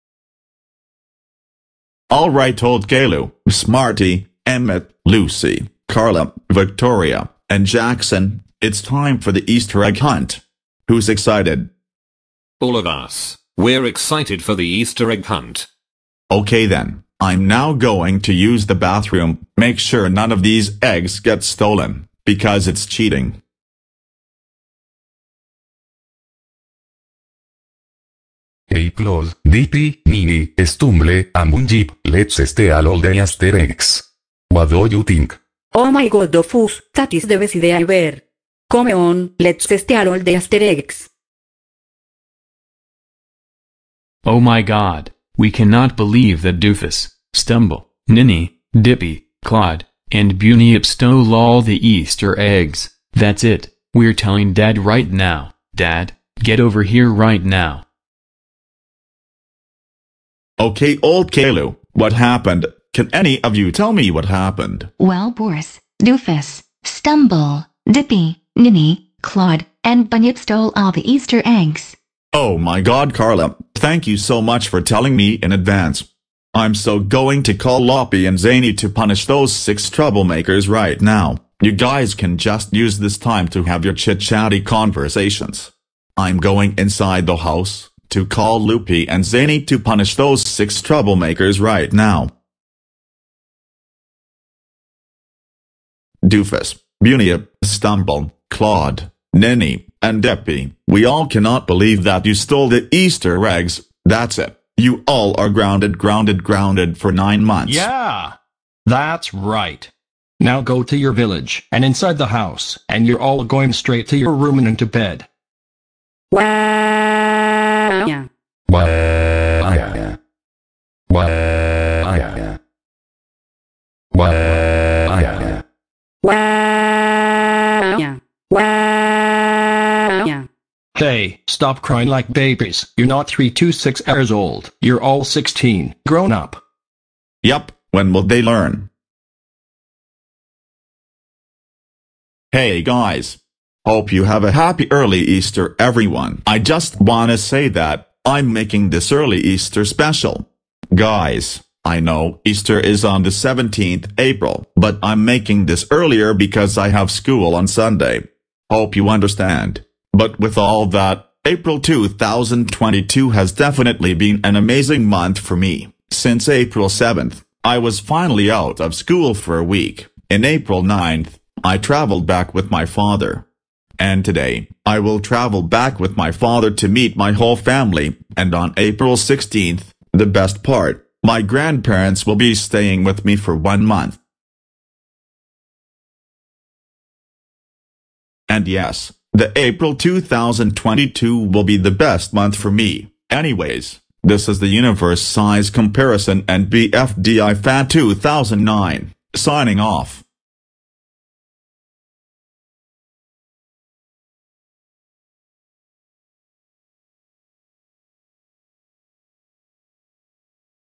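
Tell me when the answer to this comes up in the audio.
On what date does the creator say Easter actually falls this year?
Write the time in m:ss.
2:33.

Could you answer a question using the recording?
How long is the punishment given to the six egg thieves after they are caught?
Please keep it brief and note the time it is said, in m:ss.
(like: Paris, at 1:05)
9 months, at 1:47.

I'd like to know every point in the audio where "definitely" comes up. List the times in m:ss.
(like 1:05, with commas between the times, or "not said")
2:43.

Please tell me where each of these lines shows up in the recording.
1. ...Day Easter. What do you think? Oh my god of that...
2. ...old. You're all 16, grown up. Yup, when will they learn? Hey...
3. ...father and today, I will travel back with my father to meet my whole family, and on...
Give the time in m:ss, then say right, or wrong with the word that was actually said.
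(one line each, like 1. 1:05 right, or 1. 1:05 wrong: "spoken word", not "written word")
1. 0:32 wrong: "Asterix", not "Easter"
2. 2:14 right
3. 2:52 right.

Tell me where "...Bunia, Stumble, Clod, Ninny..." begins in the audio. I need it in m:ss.
1:37.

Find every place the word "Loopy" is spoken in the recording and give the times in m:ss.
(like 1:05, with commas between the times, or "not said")
1:17, 1:28.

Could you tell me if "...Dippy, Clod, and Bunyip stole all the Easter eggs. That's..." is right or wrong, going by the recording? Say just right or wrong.
right.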